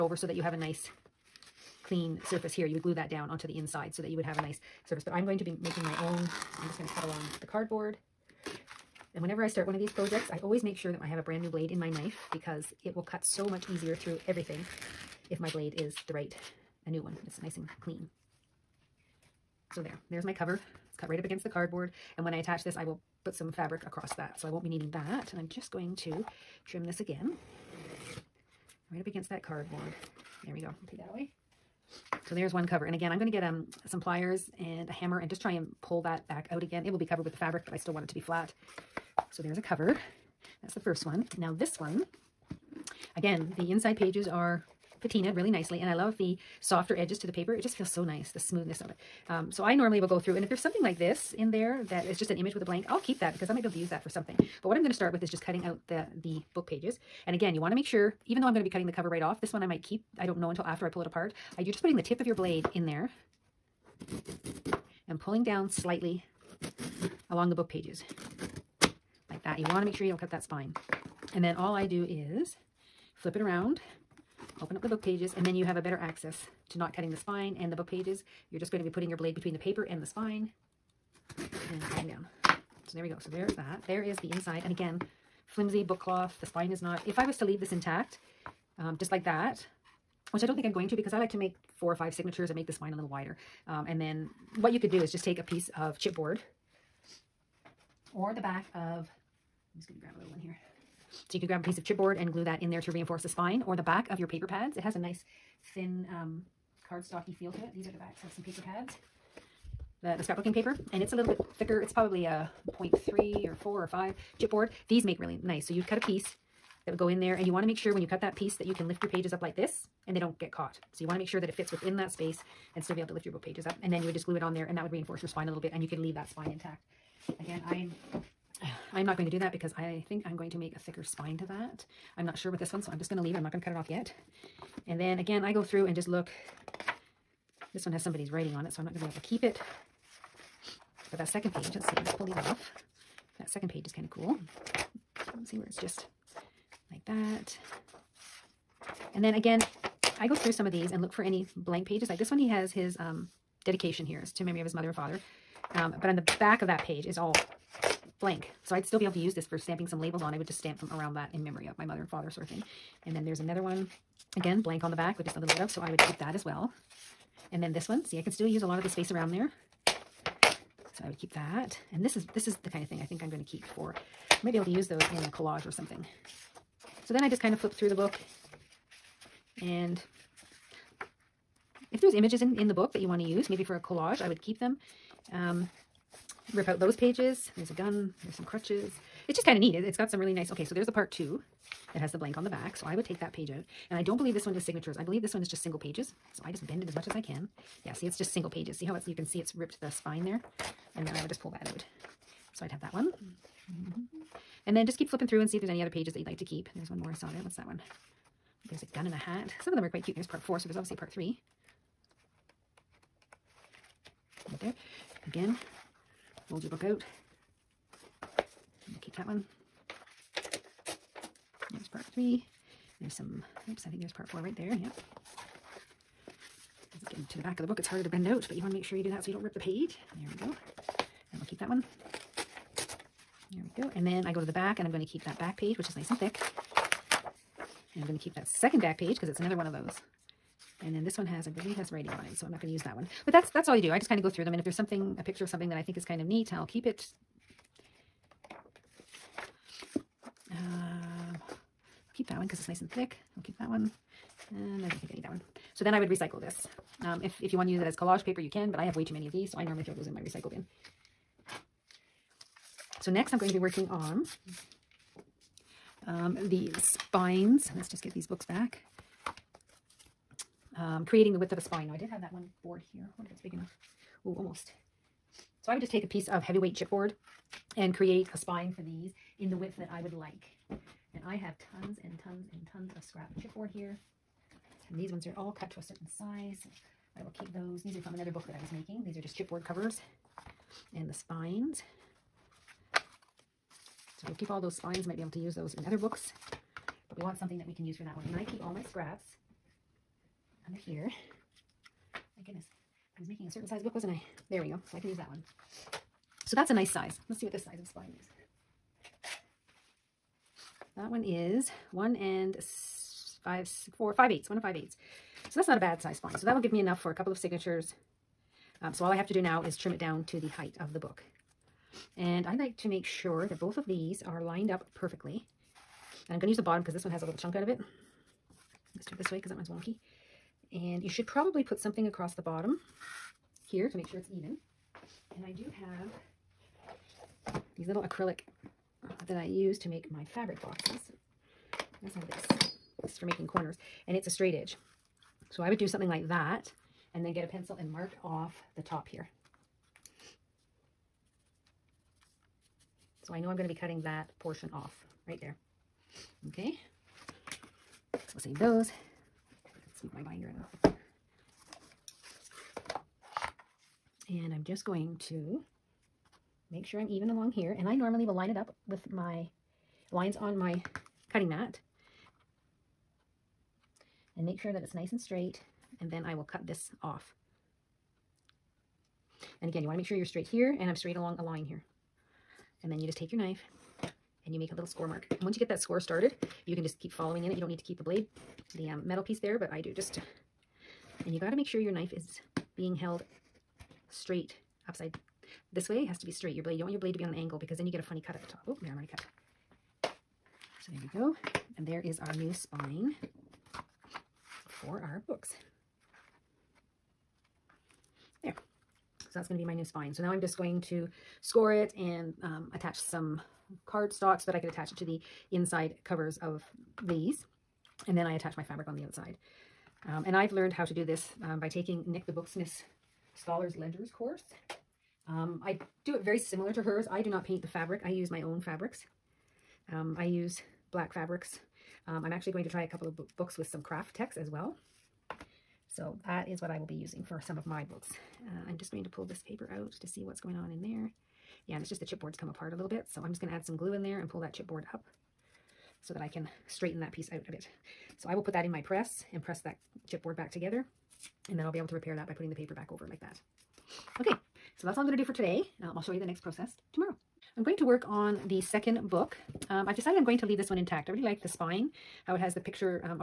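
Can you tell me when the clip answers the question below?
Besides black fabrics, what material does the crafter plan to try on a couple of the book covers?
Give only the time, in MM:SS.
07:13.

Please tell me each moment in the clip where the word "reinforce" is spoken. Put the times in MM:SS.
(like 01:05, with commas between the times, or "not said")
01:42, 02:04.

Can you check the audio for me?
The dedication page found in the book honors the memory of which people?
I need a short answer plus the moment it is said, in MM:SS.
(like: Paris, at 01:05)
His mother and father, at 02:34.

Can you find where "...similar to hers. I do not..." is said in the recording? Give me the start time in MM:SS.
07:06.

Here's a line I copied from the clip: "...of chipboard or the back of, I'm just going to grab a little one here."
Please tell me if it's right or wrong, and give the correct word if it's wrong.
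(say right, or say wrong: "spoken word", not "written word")
right.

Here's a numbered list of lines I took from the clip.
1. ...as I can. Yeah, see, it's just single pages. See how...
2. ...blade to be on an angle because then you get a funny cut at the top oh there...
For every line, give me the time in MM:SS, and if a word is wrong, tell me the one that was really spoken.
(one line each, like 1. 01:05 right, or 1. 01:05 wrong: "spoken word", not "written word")
1. 03:17 right
2. 06:36 right.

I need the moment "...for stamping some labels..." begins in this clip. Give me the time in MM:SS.
02:39.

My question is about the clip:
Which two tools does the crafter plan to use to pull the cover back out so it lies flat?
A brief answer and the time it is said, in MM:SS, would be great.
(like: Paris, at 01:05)
Pliers and a hammer, at 00:33.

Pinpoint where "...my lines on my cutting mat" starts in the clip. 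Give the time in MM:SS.
06:09.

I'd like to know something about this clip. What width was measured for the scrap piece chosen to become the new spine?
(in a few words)
1 5/8 inches.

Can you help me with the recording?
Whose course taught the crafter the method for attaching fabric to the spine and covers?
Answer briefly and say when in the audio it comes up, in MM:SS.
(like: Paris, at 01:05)
Nik the Booksmith, at 07:02.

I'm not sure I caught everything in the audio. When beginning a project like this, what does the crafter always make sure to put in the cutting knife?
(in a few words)
A brand new blade.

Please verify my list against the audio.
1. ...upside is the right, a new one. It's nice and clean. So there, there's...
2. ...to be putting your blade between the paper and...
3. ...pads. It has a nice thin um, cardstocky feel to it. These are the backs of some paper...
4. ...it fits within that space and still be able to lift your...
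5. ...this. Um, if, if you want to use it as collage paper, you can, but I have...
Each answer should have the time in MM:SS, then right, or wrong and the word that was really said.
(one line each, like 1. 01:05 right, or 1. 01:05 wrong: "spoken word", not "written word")
1. 00:15 wrong: "blade", not "upside"
2. 01:18 right
3. 01:44 right
4. 02:01 right
5. 04:16 right.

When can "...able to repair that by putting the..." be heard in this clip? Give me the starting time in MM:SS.
07:31.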